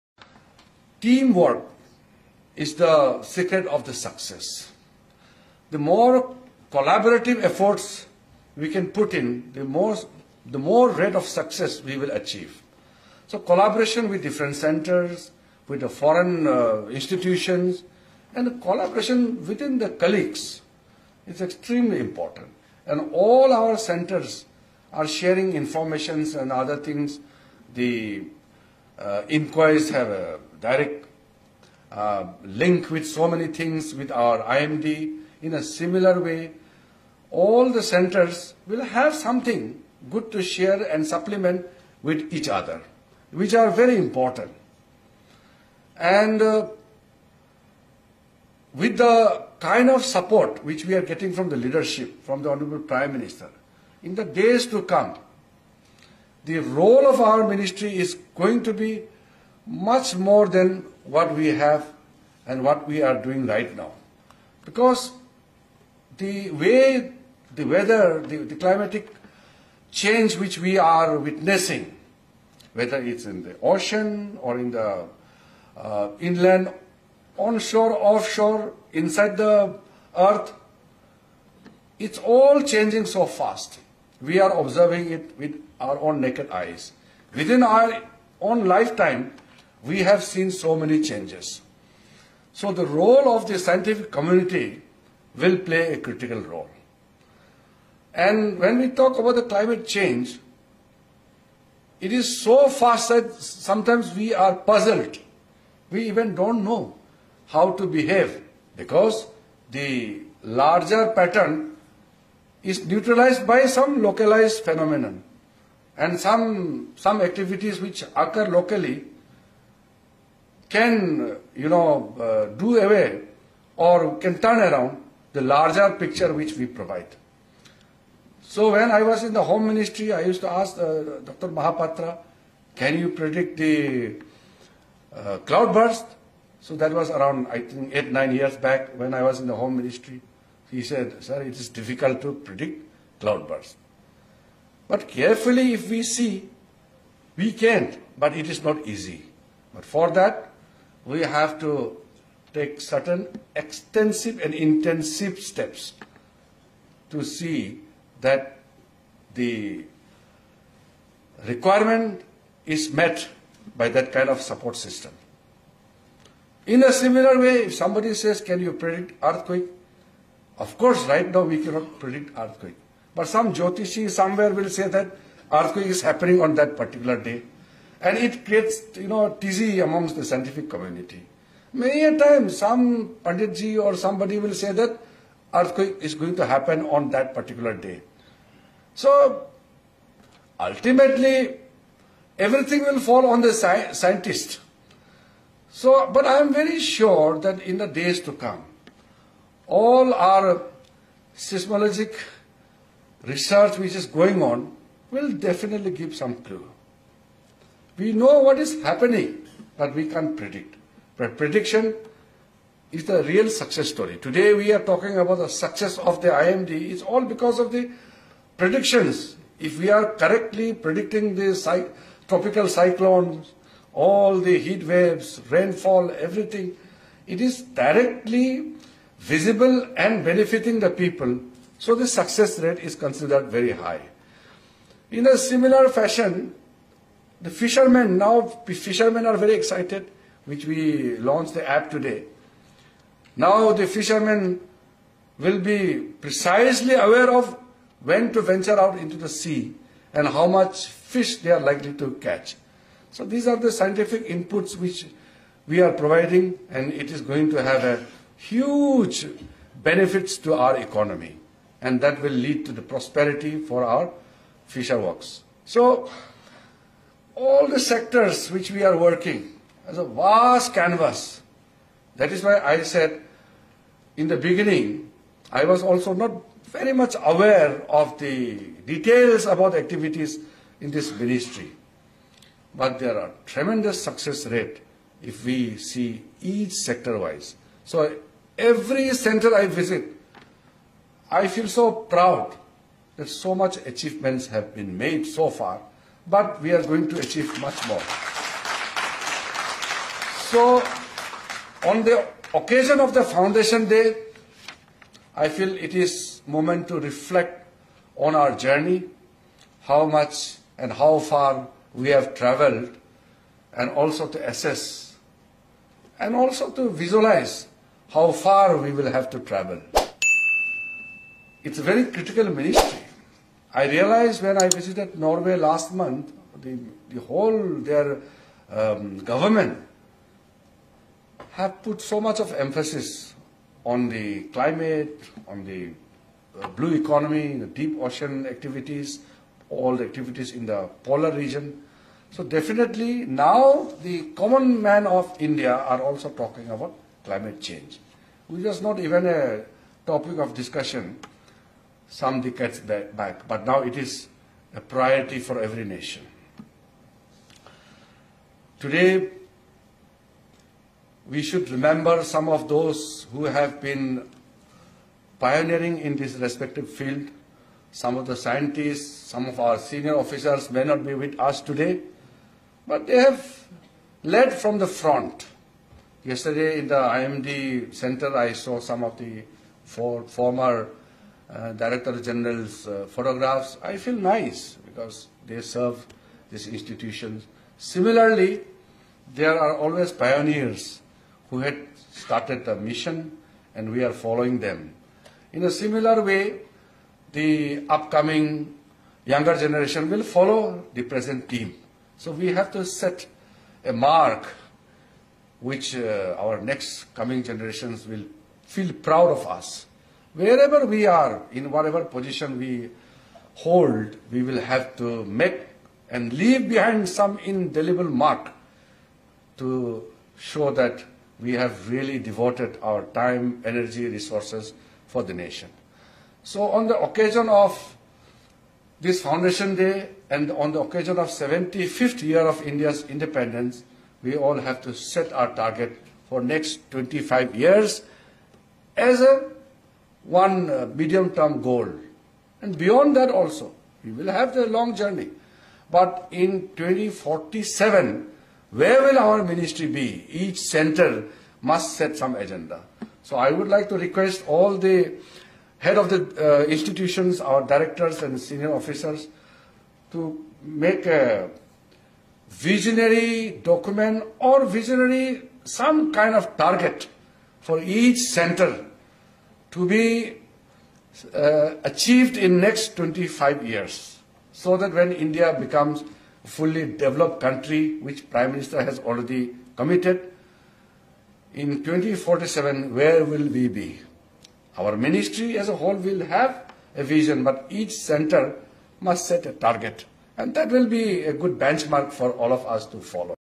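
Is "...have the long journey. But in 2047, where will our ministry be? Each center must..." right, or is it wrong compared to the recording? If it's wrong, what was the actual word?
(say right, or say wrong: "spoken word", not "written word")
right.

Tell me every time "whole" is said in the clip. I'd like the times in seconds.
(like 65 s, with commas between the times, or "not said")
327 s, 485 s.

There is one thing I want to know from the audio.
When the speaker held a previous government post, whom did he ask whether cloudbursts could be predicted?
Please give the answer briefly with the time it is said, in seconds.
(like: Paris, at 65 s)
Dr. Mahapatra, at 131 s.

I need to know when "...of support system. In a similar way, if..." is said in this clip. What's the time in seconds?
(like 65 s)
164 s.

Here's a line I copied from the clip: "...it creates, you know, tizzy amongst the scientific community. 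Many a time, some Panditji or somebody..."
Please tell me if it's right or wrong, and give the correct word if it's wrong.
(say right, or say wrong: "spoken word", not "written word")
right.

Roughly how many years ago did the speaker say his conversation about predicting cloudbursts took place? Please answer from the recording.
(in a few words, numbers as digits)
8 or 9 years.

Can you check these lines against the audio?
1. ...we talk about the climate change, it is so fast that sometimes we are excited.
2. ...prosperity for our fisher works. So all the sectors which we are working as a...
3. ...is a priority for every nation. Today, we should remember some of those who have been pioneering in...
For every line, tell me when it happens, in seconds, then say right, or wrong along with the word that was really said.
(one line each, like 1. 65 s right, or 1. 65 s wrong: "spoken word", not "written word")
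1. 98 s wrong: "puzzled", not "excited"
2. 262 s right
3. 353 s right.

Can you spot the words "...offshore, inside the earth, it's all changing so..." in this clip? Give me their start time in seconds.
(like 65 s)
78 s.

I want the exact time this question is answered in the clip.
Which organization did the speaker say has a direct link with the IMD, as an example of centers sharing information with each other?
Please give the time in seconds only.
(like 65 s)
29 s.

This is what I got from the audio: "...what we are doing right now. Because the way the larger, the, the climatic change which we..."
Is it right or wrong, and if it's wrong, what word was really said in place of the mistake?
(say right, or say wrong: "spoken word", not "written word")
wrong: "weather", not "larger".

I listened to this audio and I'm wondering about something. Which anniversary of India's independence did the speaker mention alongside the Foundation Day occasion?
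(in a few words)
75th year.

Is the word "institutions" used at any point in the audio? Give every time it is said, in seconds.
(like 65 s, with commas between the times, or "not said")
16 s, 386 s, 456 s.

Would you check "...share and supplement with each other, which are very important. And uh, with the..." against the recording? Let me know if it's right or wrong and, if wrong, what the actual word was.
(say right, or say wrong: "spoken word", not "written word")
right.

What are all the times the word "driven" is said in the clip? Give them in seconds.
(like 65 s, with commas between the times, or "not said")
not said.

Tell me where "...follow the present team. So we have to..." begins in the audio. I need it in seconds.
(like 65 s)
400 s.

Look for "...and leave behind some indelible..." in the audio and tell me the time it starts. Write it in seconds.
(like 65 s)
416 s.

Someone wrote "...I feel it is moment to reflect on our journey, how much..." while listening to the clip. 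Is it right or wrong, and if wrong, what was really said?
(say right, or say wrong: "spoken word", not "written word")
right.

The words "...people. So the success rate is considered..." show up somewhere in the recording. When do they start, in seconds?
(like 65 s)
230 s.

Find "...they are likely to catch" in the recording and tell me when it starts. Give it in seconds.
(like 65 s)
251 s.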